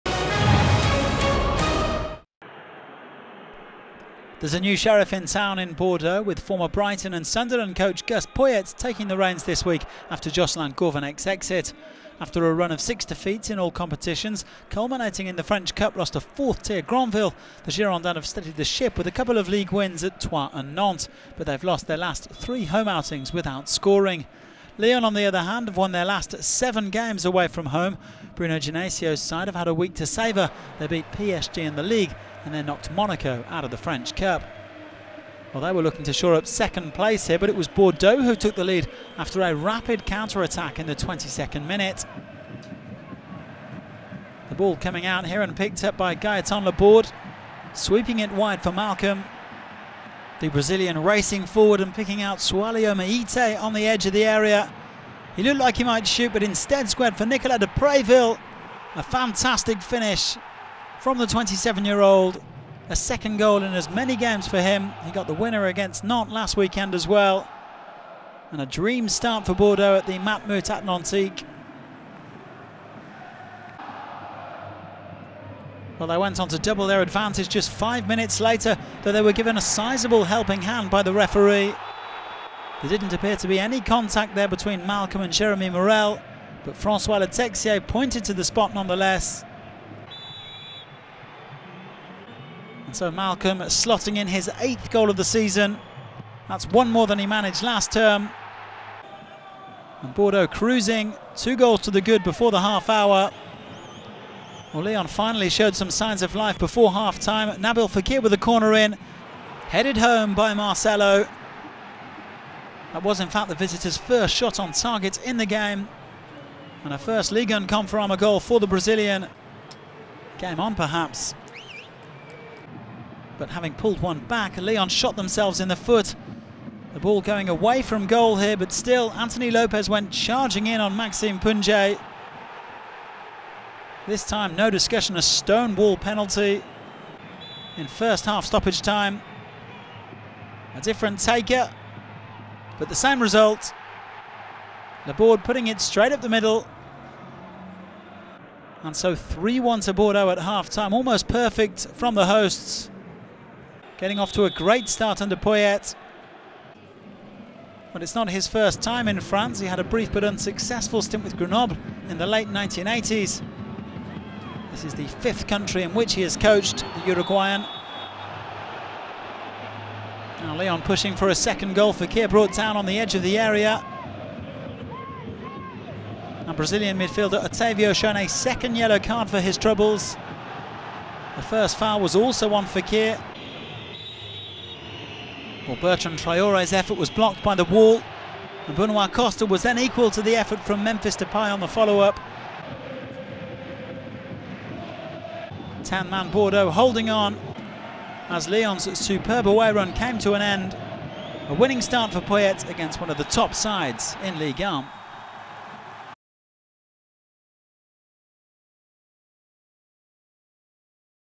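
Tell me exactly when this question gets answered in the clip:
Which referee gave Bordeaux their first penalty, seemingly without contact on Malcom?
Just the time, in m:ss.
1:26.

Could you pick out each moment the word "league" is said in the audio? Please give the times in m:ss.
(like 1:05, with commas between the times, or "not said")
0:19, 0:31.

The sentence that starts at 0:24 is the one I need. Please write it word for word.
Lyon, on the other hand, have won their last seven games away from home.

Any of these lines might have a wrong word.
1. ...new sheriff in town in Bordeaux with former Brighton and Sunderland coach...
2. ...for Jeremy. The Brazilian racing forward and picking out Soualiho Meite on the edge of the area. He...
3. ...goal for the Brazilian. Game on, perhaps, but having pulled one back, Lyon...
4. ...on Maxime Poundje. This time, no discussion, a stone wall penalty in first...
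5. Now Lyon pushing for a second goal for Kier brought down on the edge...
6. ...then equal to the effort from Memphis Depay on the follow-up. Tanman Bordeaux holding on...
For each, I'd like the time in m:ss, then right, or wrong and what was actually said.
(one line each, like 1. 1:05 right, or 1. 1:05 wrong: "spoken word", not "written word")
1. 0:04 right
2. 0:48 wrong: "Malcom", not "Jeremy"
3. 1:58 right
4. 2:10 right
5. 2:50 right
6. 3:09 right.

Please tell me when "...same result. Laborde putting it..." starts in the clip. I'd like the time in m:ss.
2:22.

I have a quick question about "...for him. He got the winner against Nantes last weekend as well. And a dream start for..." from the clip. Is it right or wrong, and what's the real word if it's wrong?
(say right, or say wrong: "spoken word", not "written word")
right.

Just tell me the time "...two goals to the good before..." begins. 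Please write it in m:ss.
1:41.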